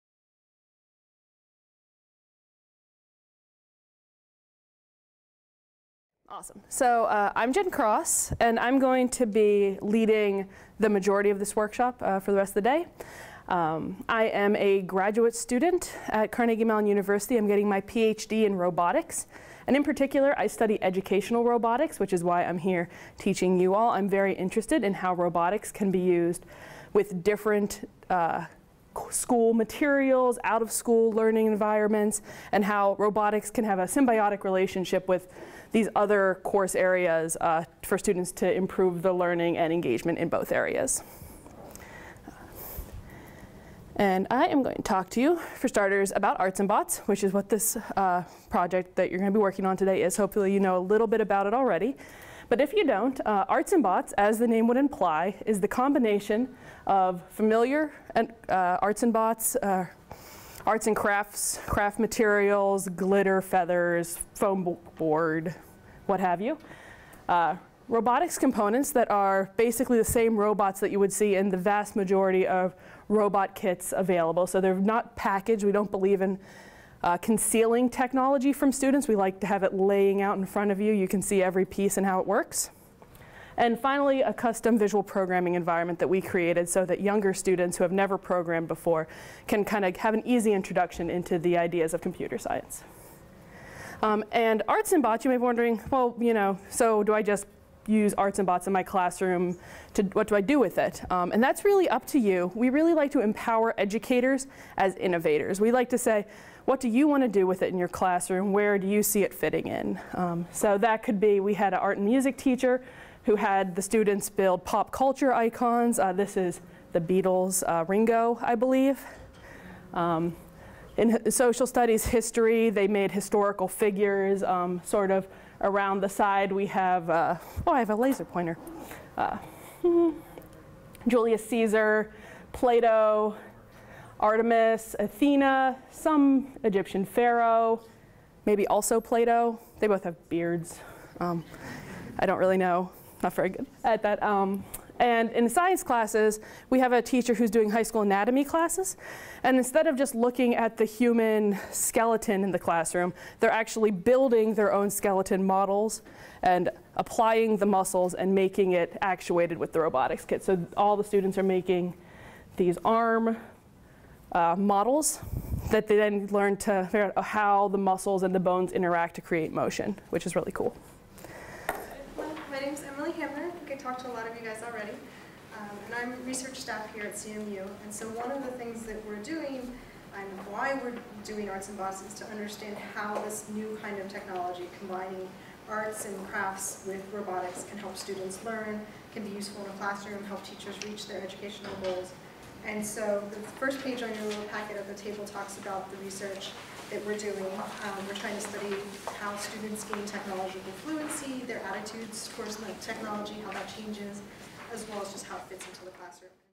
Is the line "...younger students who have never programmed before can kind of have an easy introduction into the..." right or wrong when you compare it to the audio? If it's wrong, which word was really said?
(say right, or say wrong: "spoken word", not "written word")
right.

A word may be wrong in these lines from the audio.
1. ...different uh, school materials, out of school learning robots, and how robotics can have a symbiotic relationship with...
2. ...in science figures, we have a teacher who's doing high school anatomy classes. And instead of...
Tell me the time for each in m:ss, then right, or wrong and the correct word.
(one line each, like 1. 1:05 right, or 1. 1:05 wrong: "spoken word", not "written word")
1. 0:27 wrong: "environments", not "robots"
2. 2:25 wrong: "classes", not "figures".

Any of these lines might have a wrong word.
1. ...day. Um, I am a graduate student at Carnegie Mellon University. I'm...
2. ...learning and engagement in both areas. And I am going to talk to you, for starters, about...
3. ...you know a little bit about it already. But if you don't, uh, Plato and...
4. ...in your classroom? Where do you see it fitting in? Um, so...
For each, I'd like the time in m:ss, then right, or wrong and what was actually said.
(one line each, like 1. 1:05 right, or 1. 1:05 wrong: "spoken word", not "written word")
1. 0:12 right
2. 0:39 right
3. 0:50 wrong: "Arts", not "Plato"
4. 1:47 right.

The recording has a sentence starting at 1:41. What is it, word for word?
Um, and that's really up to you.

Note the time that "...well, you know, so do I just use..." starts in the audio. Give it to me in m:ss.
1:35.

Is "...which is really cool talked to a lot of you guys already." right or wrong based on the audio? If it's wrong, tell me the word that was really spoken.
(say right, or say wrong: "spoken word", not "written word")
right.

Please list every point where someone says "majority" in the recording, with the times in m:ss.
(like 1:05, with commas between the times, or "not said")
0:10, 1:11.